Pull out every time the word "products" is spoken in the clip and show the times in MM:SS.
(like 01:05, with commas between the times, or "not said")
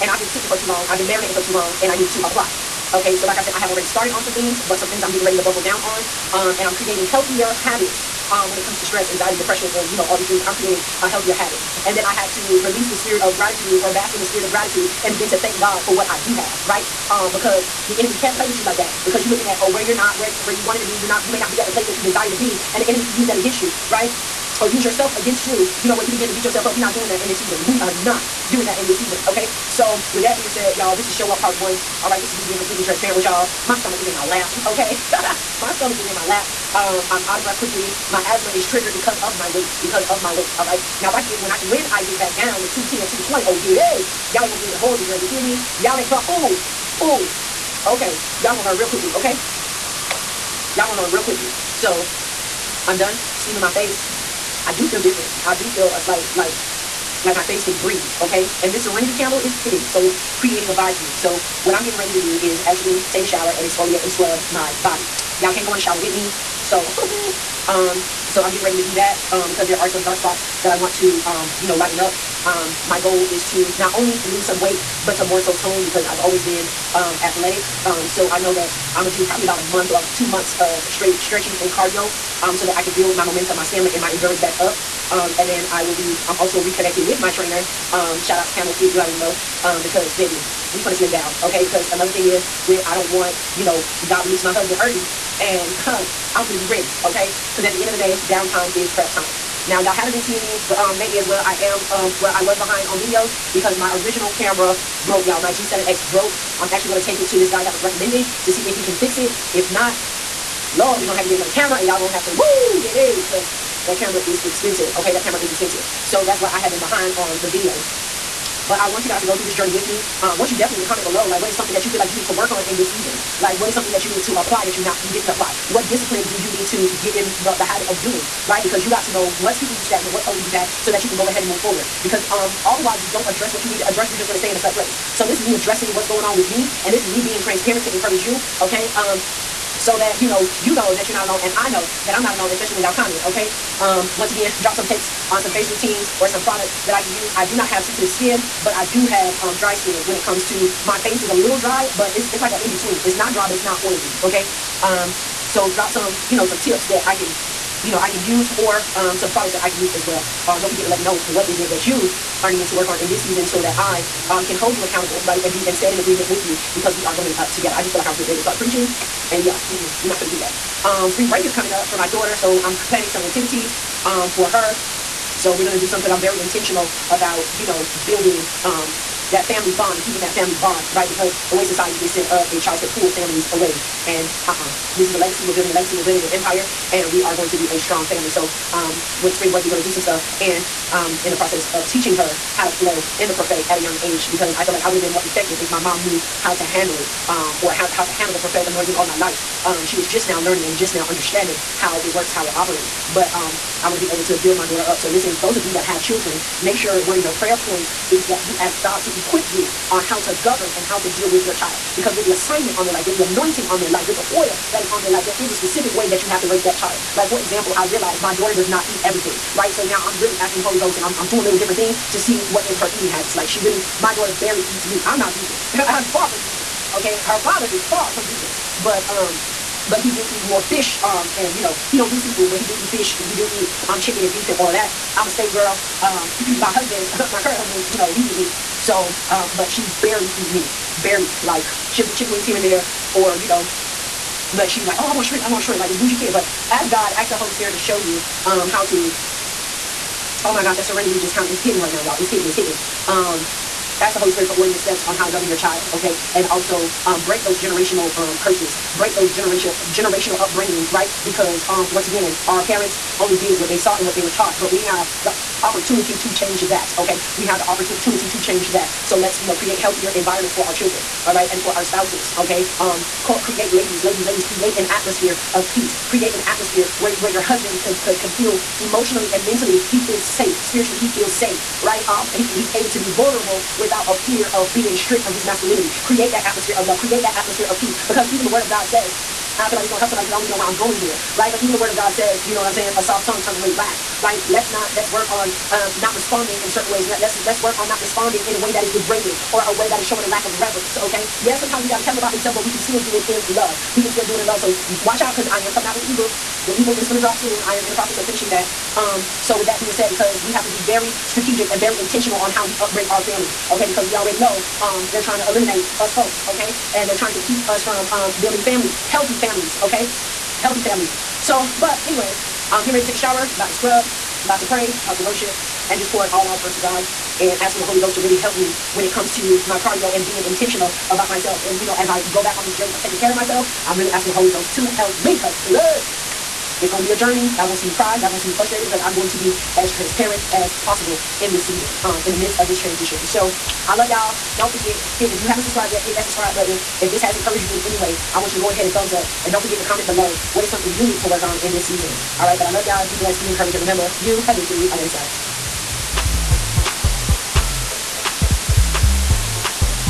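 02:26, 02:39.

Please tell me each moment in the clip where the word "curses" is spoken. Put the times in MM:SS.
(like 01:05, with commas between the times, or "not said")
04:18.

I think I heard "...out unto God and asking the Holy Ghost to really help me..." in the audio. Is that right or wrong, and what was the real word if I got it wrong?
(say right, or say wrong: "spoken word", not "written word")
right.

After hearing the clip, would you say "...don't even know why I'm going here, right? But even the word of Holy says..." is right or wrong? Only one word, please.
wrong.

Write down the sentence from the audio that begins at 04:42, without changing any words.
Um he he's able to be vulnerable without a fear of being stripped from his masculinity.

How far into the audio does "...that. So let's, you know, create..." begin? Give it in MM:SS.
04:28.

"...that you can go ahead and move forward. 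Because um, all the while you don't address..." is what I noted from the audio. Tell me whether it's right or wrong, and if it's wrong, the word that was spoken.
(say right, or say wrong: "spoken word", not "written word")
right.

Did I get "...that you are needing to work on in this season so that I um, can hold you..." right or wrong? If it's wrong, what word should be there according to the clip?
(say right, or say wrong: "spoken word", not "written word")
right.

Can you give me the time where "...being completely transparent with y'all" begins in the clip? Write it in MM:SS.
00:32.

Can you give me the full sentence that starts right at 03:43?
Like she really, my daughter barely eats meat.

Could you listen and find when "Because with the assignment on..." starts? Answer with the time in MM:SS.
03:31.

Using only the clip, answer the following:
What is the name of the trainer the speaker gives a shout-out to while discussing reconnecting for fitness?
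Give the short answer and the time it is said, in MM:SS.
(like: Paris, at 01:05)
Camo Fit, at 01:28.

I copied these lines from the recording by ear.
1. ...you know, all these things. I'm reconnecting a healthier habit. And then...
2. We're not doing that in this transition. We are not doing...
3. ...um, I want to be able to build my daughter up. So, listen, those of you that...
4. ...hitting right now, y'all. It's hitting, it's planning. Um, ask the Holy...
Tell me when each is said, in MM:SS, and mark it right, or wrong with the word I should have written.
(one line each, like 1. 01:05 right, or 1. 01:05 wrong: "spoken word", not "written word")
1. 00:09 wrong: "creating", not "reconnecting"
2. 00:26 wrong: "season", not "transition"
3. 03:23 right
4. 04:11 wrong: "hitting", not "planning".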